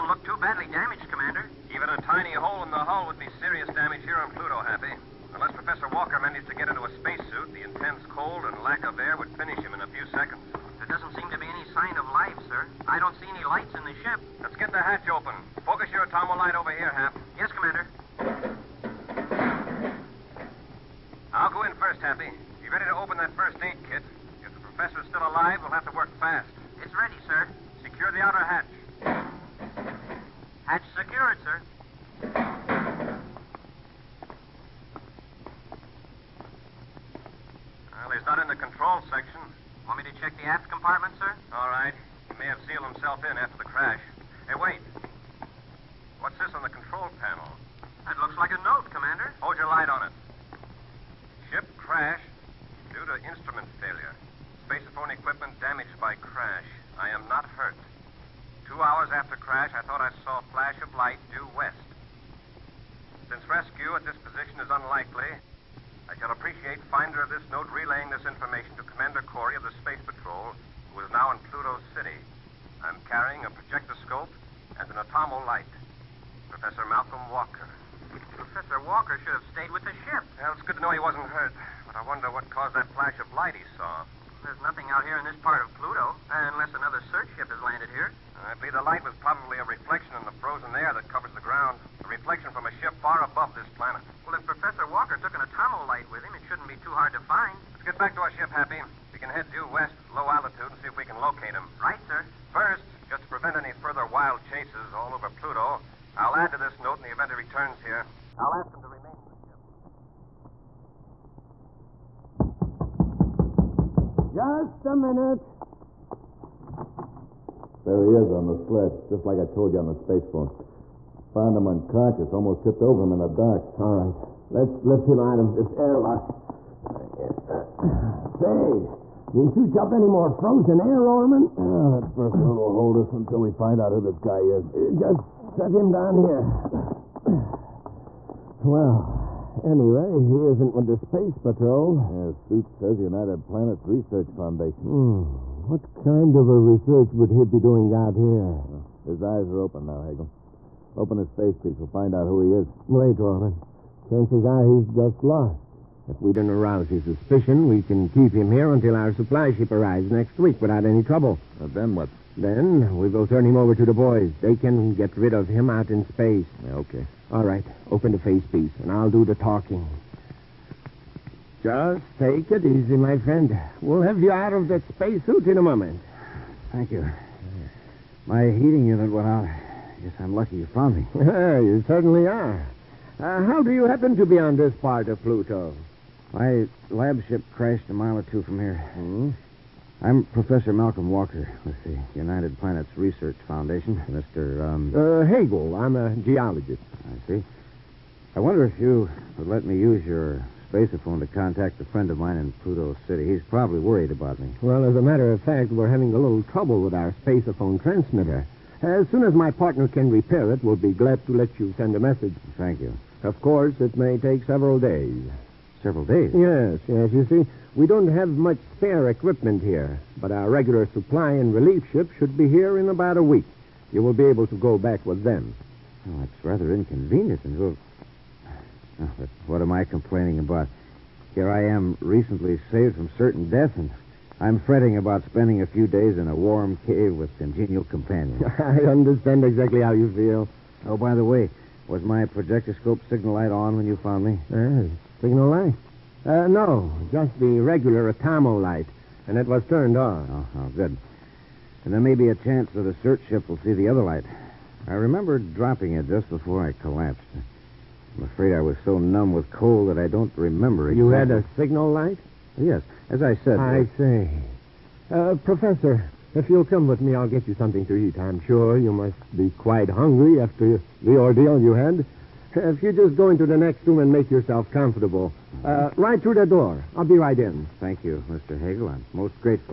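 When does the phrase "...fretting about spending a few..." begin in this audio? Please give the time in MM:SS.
03:54.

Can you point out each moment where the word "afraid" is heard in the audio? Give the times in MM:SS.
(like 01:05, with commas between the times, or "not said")
04:18.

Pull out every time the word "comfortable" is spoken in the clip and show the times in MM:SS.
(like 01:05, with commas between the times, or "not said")
04:34.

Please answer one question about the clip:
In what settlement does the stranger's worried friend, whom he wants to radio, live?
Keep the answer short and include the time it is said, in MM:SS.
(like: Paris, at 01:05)
Pluto City, at 03:22.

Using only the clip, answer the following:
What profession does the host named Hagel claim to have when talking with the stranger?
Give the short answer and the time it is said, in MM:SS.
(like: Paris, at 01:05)
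Geologist, at 03:16.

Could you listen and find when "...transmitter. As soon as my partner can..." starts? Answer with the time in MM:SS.
03:27.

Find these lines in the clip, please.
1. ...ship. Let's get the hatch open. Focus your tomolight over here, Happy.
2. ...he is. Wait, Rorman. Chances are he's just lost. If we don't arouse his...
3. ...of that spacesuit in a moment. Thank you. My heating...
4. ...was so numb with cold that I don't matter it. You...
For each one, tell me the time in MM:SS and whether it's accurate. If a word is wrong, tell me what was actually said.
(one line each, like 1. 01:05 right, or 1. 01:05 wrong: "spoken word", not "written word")
1. 00:14 right
2. 02:32 right
3. 02:54 right
4. 04:18 wrong: "remember", not "matter".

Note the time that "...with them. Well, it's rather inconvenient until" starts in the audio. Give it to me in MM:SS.
03:45.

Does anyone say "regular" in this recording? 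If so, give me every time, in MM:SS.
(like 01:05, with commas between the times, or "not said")
03:40, 04:07.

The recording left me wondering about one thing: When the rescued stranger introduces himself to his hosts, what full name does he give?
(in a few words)
Malcolm Walker.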